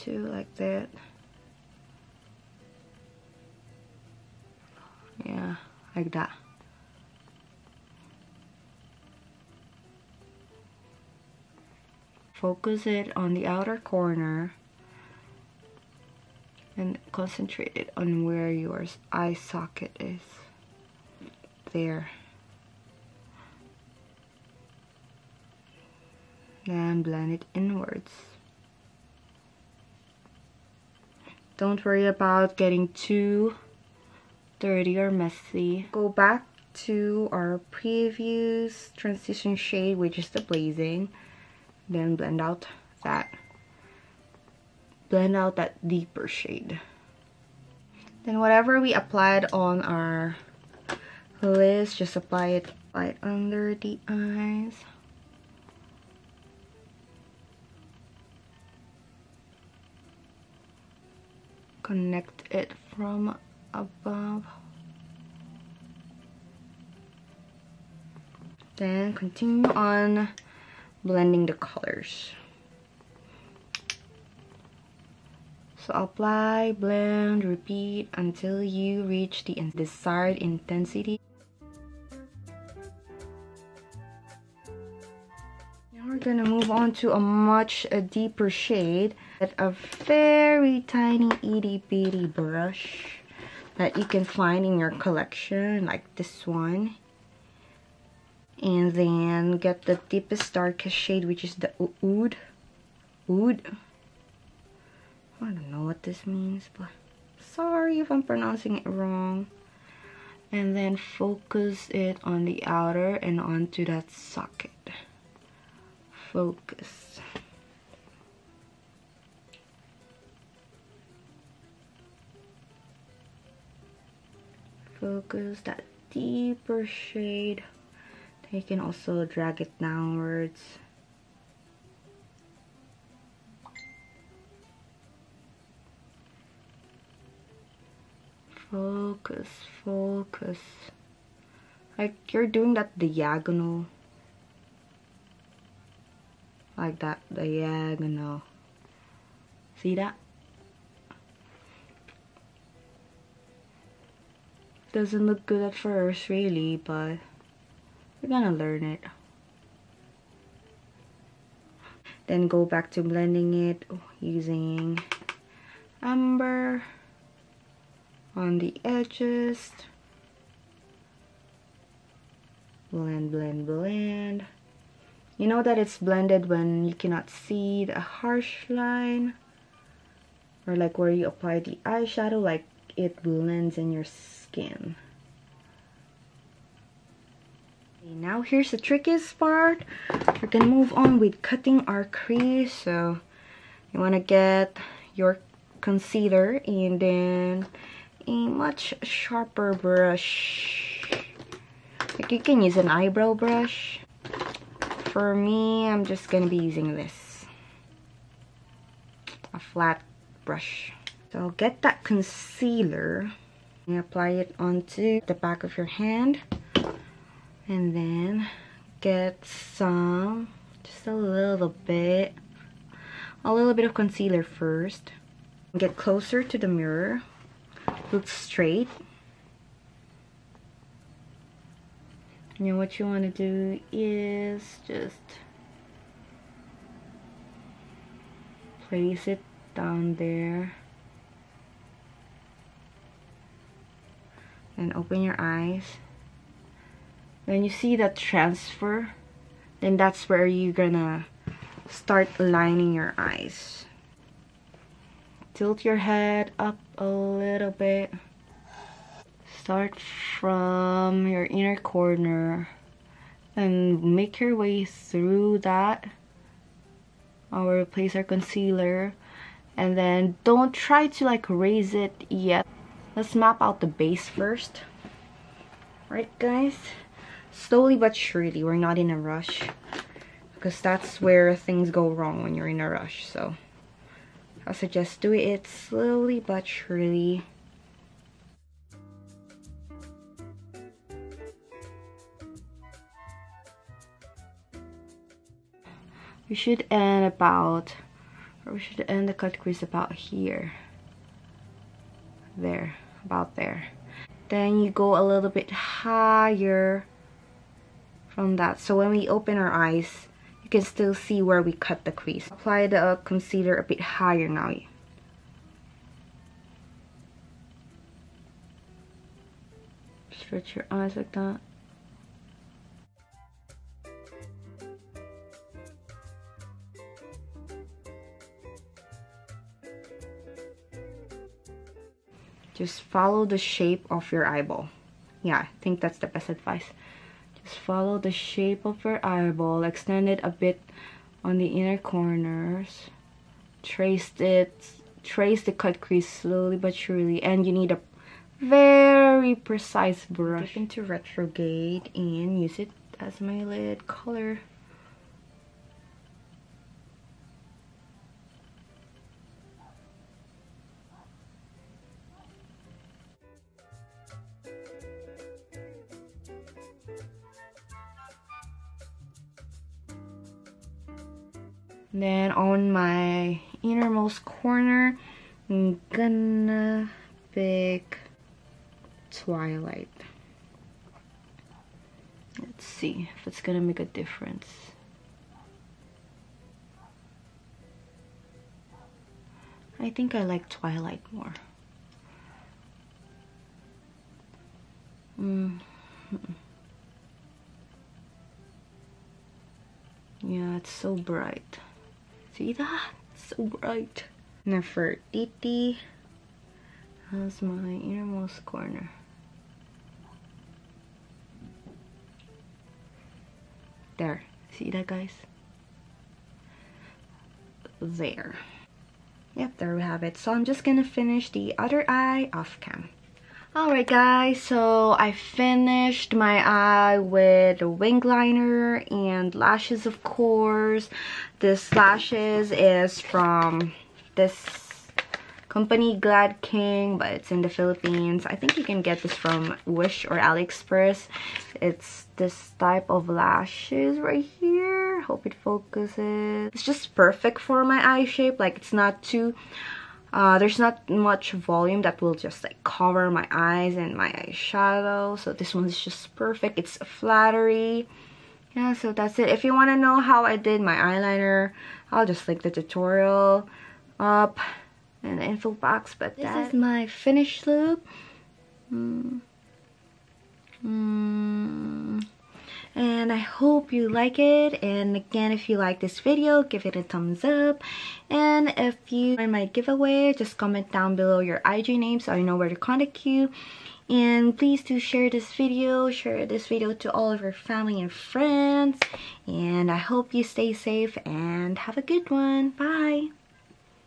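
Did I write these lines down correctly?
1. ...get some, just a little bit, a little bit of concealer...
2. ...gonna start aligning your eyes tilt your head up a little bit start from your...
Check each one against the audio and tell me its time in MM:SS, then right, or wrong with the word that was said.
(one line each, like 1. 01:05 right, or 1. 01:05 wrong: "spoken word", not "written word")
1. 03:38 right
2. 04:10 right.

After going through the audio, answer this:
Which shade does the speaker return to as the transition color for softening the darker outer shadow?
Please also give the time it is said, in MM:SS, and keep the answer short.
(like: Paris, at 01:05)
Blazing, at 00:40.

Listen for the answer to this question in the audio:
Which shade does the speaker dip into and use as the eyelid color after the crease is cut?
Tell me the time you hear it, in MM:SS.
05:51.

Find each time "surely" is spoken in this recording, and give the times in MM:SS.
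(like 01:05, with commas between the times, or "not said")
04:38, 04:46, 05:46.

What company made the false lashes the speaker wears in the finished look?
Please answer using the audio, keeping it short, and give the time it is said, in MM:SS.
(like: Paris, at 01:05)
Glad King, at 07:16.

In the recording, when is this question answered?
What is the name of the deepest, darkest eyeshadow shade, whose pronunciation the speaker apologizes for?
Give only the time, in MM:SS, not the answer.
01:42.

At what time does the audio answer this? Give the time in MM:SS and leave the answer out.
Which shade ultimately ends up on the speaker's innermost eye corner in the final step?
06:44.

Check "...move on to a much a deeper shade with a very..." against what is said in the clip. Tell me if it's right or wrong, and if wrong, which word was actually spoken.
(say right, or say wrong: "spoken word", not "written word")
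right.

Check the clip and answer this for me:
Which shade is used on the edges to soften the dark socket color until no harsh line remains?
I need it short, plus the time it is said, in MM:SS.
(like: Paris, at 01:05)
Amber, at 02:46.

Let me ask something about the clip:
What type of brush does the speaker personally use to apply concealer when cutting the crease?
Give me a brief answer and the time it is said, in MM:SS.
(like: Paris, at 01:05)
A flat brush, at 03:29.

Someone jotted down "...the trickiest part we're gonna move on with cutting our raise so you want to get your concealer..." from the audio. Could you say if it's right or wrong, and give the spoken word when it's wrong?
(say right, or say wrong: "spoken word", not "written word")
wrong: "crease", not "raise".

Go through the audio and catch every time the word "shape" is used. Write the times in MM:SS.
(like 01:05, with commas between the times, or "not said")
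05:33, 05:38, 07:28.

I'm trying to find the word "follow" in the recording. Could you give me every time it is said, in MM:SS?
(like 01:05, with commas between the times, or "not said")
05:33, 05:37.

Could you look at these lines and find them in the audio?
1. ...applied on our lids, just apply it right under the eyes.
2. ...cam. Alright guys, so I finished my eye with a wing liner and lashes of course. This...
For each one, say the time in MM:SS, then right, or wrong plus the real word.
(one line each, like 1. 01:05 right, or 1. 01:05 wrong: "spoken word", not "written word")
1. 00:48 right
2. 07:02 right.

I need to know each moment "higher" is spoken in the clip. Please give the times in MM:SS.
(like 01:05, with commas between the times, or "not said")
05:05, 05:13.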